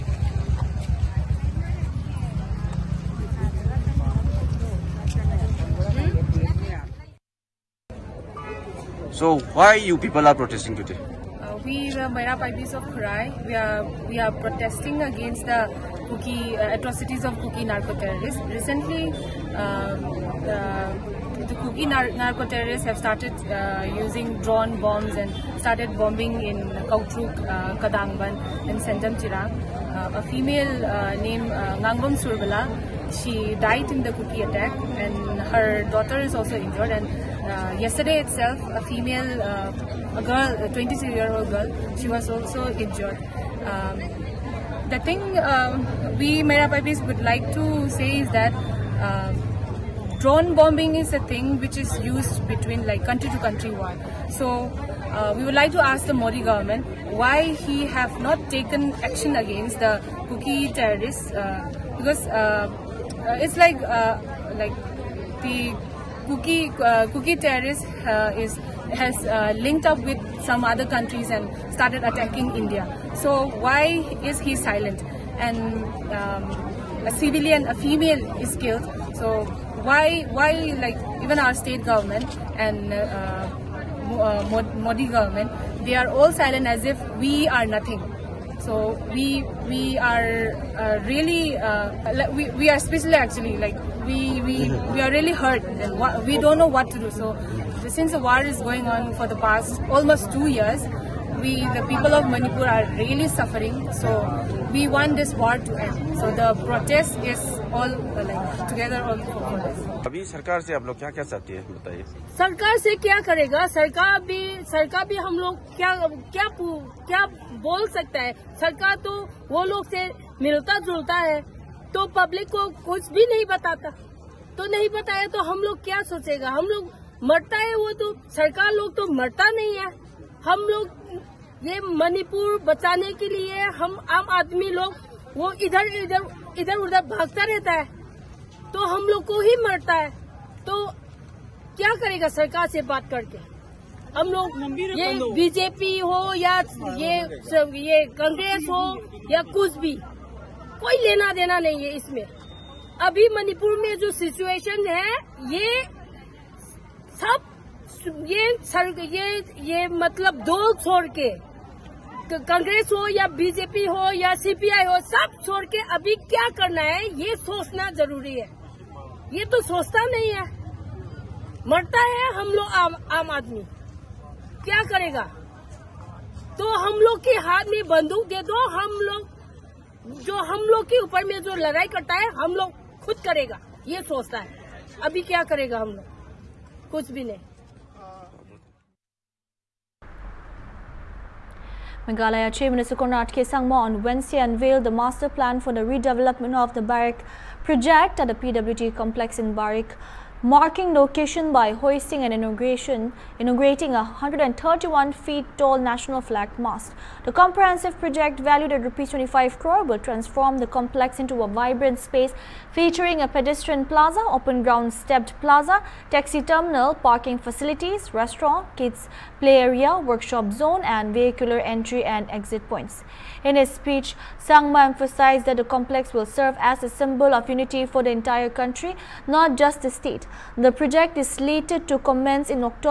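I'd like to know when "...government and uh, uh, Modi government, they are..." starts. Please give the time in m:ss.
1:21.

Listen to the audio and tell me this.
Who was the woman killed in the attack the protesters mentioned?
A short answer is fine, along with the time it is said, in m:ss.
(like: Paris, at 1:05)
Ngangbom Surbala, at 0:31.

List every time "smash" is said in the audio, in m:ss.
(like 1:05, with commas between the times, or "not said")
not said.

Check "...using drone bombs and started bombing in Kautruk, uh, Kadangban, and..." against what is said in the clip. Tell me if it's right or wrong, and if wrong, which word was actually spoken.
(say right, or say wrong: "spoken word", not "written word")
right.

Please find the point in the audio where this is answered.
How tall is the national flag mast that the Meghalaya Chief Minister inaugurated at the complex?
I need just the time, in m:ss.
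3:24.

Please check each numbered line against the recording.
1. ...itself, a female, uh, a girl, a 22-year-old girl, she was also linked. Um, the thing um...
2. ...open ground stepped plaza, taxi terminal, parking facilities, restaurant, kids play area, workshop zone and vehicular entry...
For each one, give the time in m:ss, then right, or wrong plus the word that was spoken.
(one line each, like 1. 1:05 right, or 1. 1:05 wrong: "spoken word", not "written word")
1. 0:38 wrong: "injured", not "linked"
2. 3:34 right.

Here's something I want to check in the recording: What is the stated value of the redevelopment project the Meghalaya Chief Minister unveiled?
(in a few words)
Rs 25 crore.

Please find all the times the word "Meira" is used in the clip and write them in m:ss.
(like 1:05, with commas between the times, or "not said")
0:12, 0:46.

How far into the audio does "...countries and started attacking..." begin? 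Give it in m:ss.
1:10.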